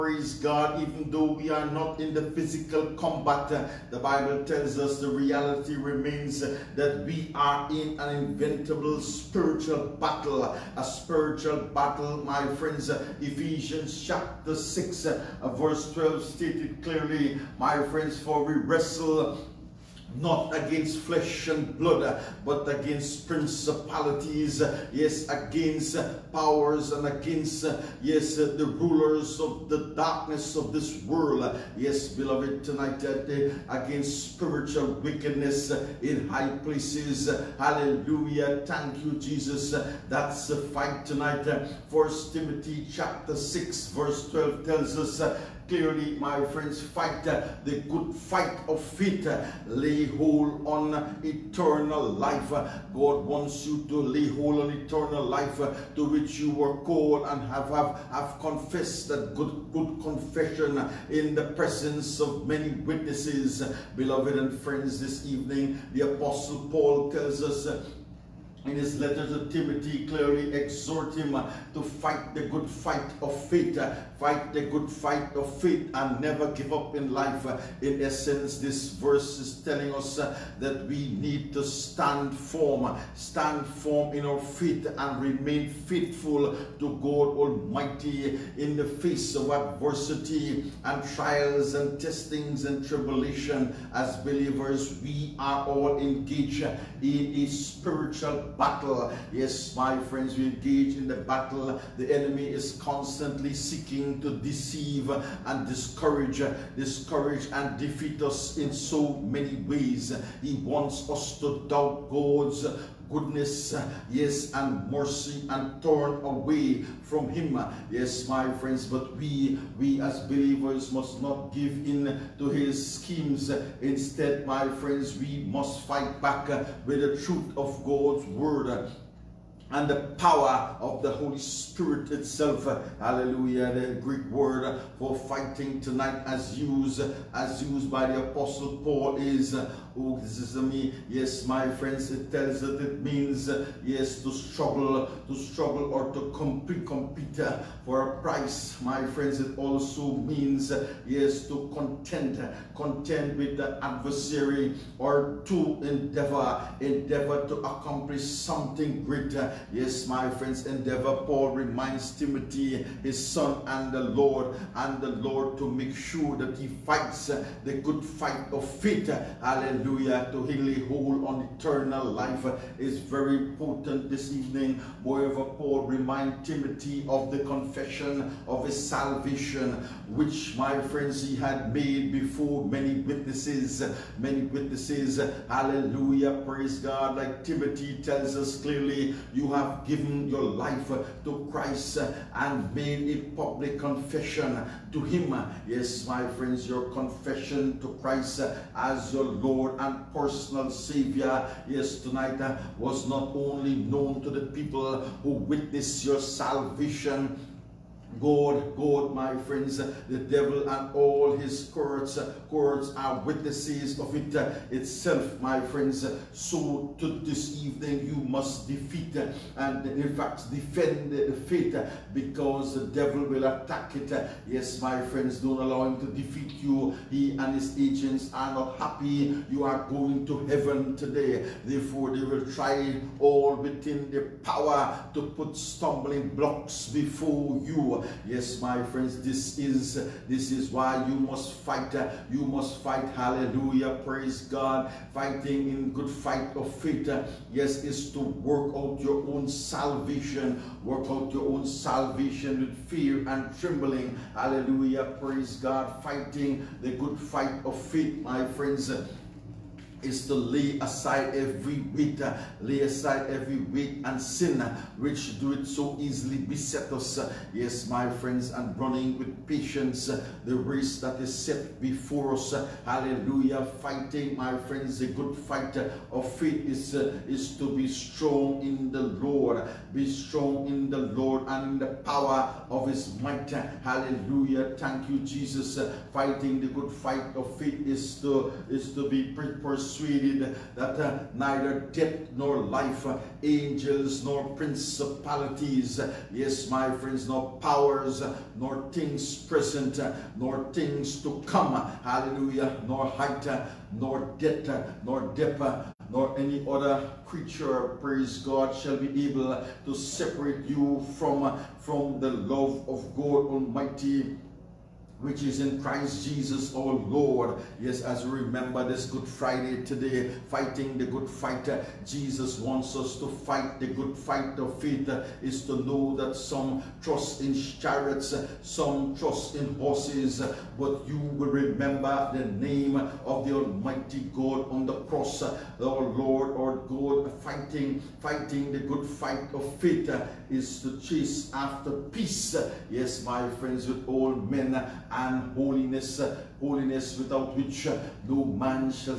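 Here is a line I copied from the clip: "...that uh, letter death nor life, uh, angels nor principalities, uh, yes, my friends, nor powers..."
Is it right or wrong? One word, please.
wrong.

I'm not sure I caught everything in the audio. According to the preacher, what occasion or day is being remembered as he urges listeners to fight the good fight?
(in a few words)
Good Friday.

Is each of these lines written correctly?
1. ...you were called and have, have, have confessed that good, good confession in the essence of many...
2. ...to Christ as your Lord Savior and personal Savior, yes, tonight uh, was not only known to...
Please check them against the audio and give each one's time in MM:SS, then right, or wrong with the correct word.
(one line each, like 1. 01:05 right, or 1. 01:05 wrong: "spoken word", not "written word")
1. 00:56 wrong: "presence", not "essence"
2. 03:17 wrong: "Lord", not "Savior".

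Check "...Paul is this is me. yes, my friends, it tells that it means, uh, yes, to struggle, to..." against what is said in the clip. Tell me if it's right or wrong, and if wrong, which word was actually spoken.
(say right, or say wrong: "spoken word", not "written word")
right.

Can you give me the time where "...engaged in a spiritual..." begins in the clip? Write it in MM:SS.
01:35.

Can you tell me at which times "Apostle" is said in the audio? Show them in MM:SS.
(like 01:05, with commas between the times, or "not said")
01:06, 02:18.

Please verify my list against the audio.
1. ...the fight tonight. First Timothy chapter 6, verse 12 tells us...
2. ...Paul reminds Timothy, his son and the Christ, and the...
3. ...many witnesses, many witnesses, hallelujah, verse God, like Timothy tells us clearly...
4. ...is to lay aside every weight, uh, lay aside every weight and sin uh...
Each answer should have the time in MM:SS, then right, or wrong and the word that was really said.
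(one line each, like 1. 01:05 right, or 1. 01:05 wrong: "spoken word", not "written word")
1. 00:40 right
2. 02:41 wrong: "Lord", not "Christ"
3. 03:02 wrong: "praise", not "verse"
4. 04:20 right.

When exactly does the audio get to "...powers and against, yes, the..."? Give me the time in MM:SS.
00:26.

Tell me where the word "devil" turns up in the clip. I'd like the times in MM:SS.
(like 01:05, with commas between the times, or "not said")
03:30, 03:42.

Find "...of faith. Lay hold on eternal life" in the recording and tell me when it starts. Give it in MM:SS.
00:48.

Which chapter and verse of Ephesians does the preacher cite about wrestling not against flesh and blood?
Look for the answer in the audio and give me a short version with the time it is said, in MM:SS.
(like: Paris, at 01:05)
chapter 6, verse 12, at 00:13.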